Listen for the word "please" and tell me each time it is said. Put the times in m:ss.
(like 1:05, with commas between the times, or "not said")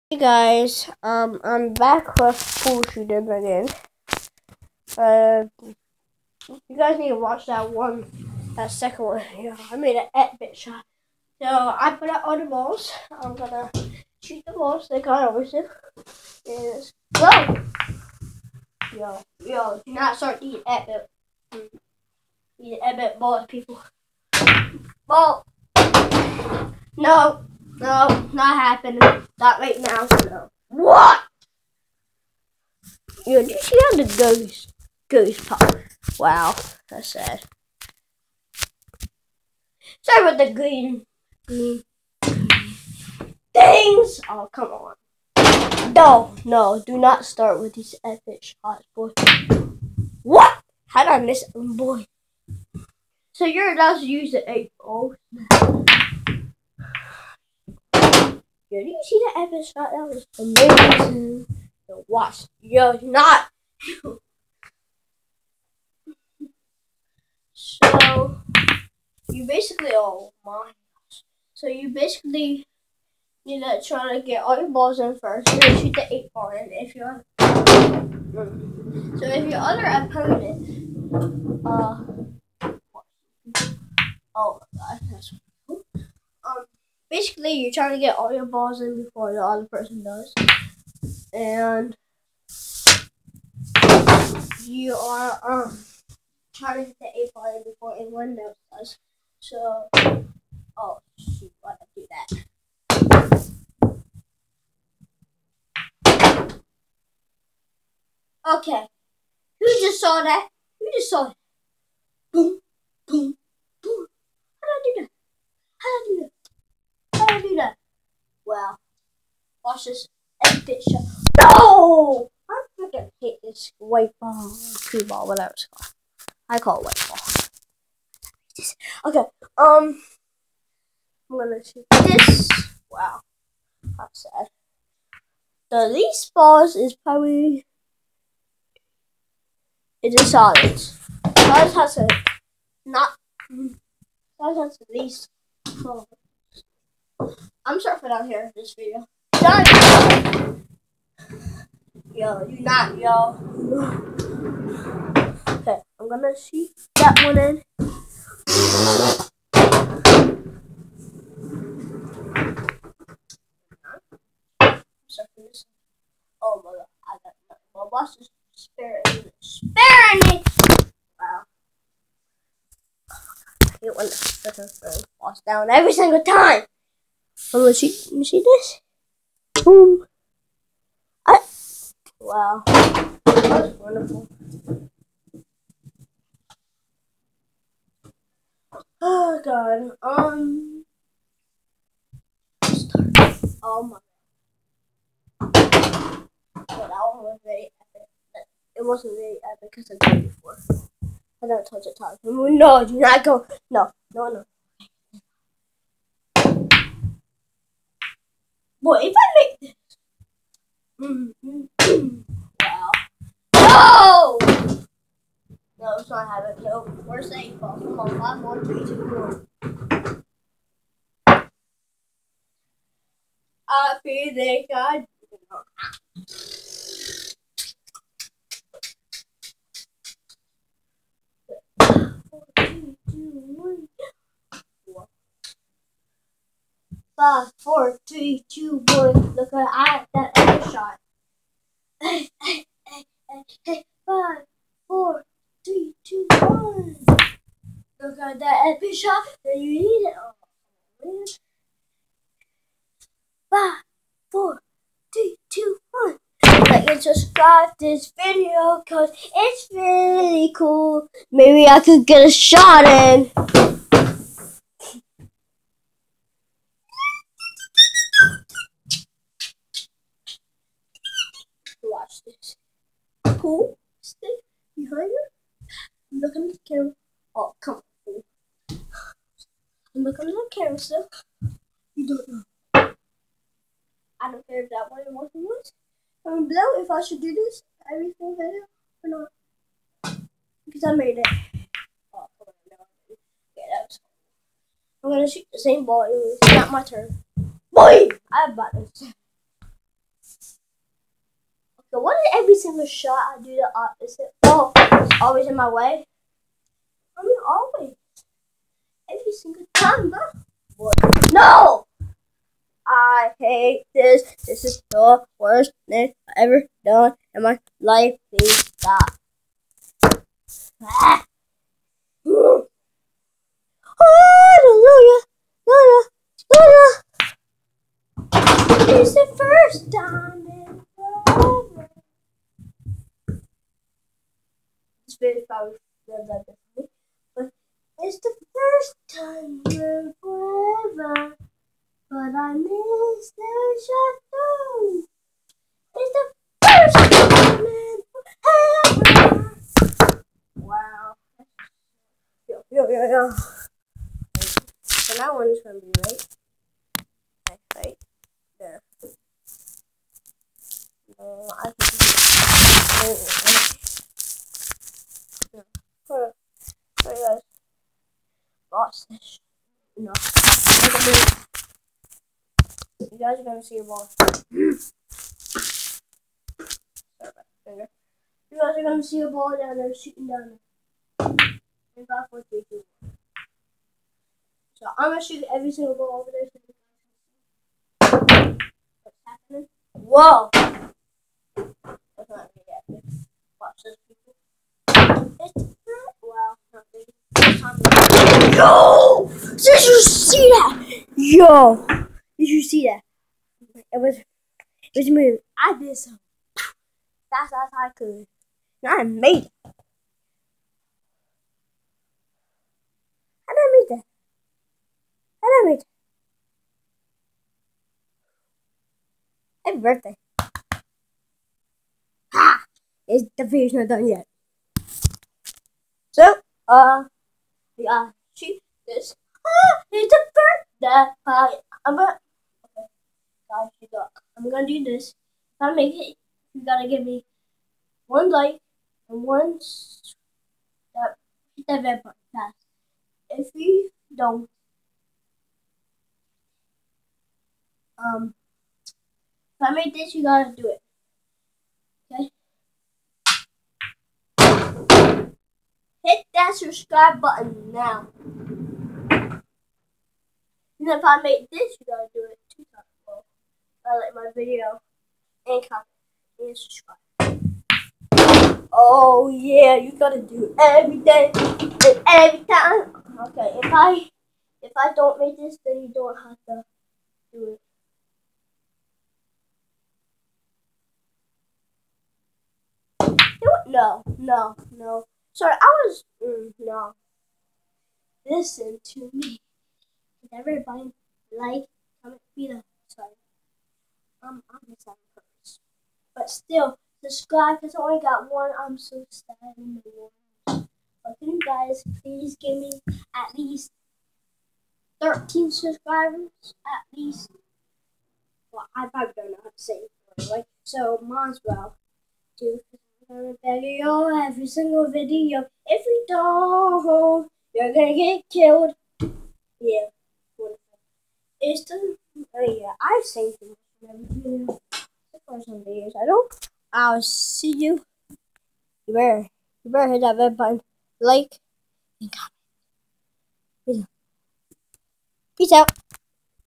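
5:18, 8:22.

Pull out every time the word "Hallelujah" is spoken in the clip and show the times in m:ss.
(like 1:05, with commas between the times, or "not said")
5:22.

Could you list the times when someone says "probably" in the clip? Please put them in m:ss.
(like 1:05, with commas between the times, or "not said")
2:16, 8:28.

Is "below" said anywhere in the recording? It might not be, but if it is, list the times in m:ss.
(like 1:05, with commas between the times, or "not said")
4:46.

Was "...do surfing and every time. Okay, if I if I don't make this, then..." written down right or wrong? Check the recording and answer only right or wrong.
wrong.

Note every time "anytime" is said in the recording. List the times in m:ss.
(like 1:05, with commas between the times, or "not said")
not said.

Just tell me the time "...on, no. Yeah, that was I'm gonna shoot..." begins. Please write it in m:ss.
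4:52.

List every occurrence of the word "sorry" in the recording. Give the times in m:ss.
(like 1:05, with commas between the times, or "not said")
0:40, 8:05, 8:12.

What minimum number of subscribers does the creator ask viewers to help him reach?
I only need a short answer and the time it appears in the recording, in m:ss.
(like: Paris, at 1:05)
13, at 8:23.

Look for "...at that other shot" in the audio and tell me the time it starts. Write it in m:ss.
3:59.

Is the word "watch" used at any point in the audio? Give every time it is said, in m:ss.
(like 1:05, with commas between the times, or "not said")
0:07, 1:02, 1:59, 6:33.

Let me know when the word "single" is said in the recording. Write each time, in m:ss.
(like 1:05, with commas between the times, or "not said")
2:55, 4:48, 5:02, 5:09, 6:25, 8:34.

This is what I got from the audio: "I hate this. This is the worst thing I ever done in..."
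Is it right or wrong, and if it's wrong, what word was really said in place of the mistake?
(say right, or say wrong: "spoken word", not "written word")
right.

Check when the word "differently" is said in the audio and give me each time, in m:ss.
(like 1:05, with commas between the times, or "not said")
5:36.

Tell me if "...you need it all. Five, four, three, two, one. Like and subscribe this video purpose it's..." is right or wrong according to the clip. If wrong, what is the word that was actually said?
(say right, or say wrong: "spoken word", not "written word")
wrong: "cause", not "purpose".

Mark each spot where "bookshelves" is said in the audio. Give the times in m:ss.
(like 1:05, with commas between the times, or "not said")
not said.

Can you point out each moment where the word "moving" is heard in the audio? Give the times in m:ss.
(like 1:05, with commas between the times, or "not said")
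6:45.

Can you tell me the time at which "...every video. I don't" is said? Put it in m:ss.
8:43.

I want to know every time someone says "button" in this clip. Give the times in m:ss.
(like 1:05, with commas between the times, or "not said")
7:22, 7:37, 8:50.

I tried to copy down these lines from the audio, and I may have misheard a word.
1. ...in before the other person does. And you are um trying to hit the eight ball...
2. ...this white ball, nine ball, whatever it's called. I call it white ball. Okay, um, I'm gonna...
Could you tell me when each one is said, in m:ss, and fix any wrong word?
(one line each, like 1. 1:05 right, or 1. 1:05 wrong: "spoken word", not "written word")
1. 1:28 right
2. 2:03 wrong: "two", not "nine".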